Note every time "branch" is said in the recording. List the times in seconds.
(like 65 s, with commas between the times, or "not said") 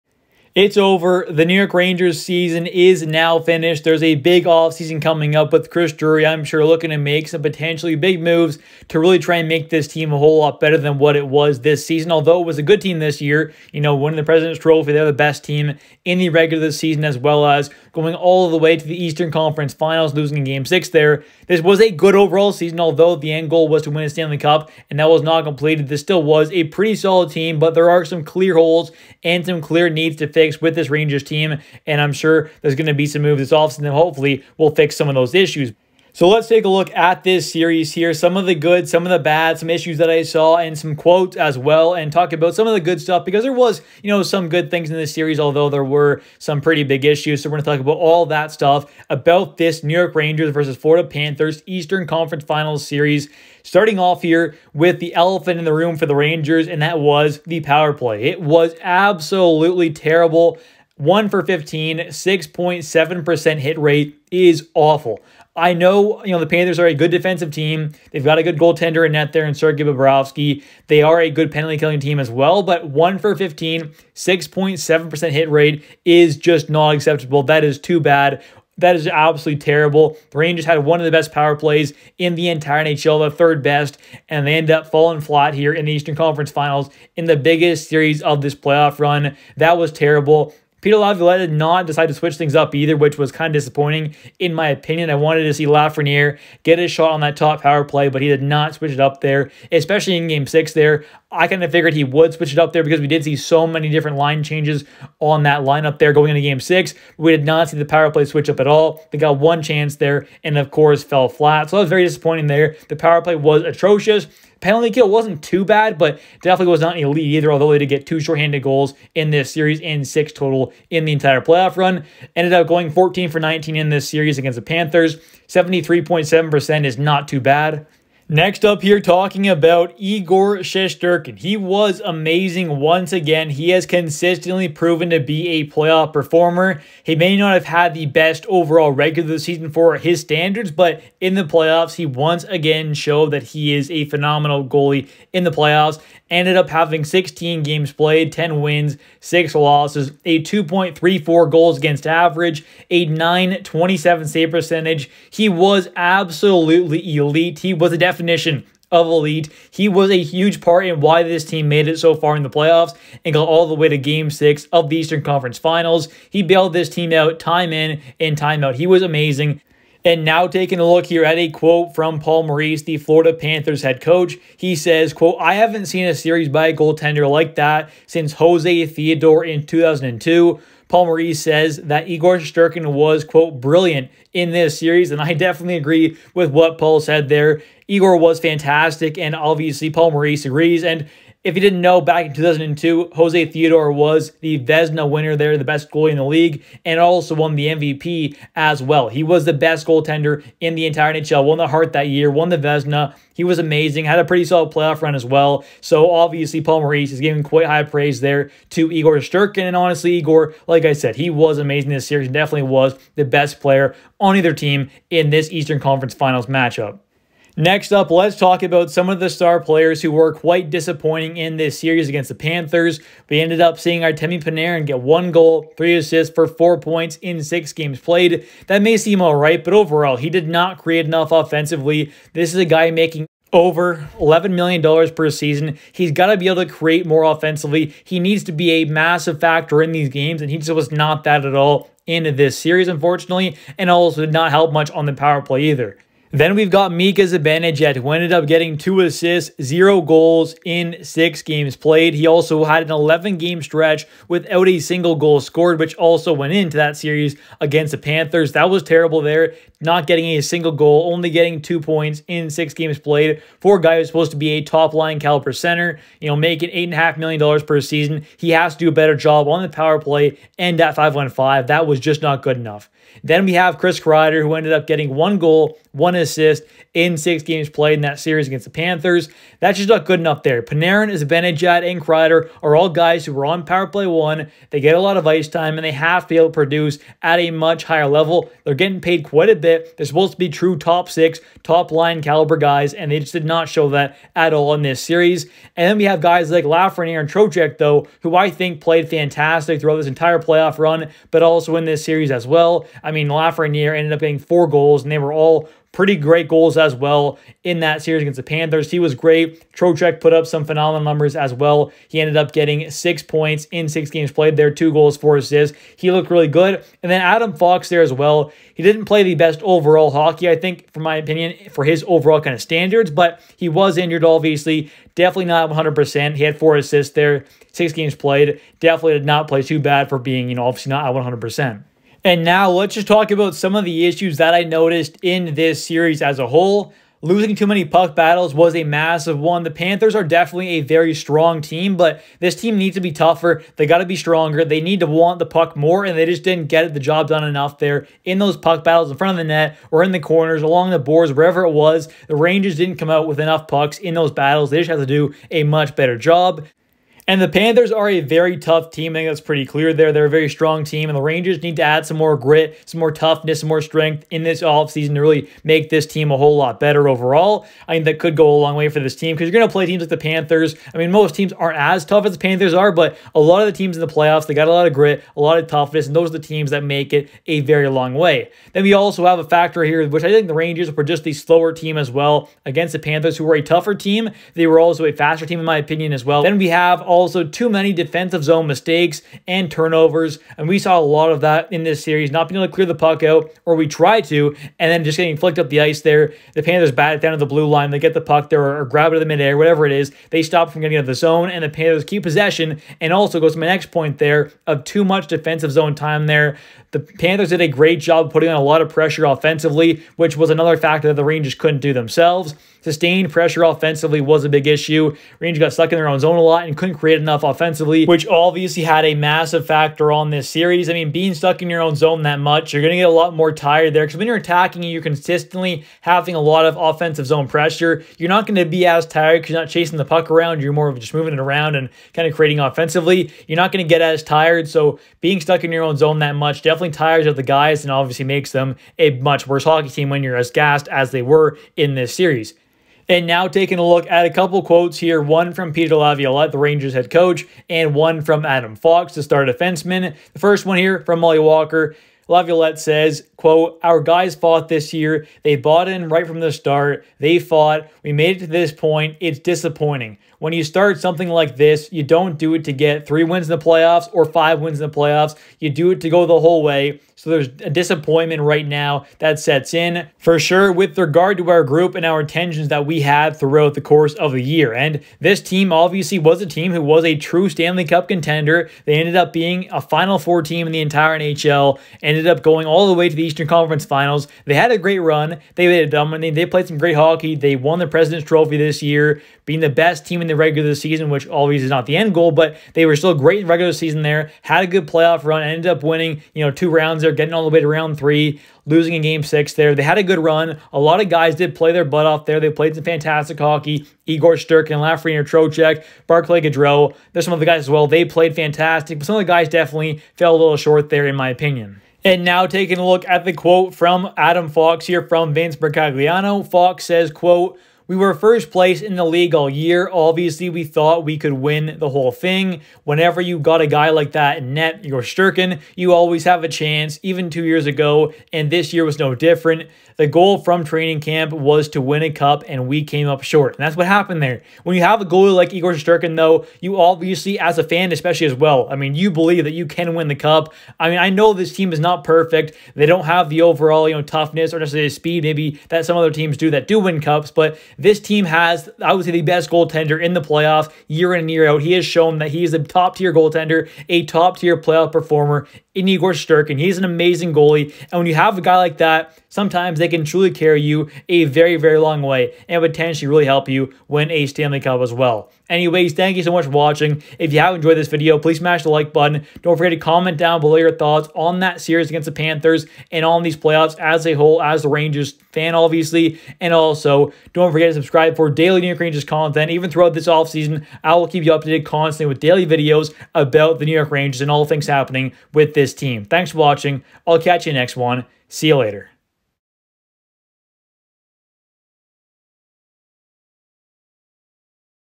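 not said.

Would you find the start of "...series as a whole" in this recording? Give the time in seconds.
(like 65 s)
335 s.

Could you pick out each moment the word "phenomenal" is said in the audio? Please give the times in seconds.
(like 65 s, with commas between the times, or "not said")
144 s, 310 s.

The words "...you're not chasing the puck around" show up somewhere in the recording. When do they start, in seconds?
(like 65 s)
429 s.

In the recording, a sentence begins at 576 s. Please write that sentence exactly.
And also, don't forget to subscribe for daily New York Rangers content.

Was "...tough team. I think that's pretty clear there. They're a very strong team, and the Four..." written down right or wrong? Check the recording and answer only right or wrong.
wrong.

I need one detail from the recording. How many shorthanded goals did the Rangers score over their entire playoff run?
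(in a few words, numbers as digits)
6.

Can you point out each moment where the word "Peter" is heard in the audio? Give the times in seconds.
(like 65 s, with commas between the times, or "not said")
90 s, 445 s.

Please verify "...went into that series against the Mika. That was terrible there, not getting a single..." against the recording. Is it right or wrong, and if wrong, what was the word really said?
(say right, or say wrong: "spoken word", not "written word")
wrong: "Panthers", not "Mika".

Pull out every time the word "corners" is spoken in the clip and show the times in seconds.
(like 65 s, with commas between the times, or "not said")
350 s.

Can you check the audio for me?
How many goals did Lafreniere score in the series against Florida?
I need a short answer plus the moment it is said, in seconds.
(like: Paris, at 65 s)
4, at 304 s.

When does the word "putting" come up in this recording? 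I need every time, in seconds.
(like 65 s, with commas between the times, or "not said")
408 s.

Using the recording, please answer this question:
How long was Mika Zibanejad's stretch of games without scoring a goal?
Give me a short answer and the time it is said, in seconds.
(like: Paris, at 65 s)
11 games, at 252 s.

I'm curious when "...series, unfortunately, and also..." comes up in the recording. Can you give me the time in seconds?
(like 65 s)
242 s.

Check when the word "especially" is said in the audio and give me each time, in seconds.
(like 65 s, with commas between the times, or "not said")
99 s, 537 s.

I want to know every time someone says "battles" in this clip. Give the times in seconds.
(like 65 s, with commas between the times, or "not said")
338 s, 348 s, 354 s.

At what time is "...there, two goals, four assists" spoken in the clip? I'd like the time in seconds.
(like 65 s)
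314 s.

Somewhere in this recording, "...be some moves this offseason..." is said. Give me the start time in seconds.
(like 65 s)
32 s.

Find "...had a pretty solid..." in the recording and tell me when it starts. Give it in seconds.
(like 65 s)
204 s.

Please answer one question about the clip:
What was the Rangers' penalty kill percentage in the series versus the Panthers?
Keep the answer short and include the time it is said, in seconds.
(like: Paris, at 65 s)
73.7%, at 125 s.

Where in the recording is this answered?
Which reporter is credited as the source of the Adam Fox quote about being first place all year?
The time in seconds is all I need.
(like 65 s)
515 s.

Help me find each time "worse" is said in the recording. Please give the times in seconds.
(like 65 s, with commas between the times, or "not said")
439 s.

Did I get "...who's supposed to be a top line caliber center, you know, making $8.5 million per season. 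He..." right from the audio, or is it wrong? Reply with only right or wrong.
right.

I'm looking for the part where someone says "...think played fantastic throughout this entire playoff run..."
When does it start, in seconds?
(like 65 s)
298 s.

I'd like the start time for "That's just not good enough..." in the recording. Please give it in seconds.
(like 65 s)
279 s.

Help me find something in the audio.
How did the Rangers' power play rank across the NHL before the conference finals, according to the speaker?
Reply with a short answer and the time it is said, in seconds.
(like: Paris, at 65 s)
Third best, at 83 s.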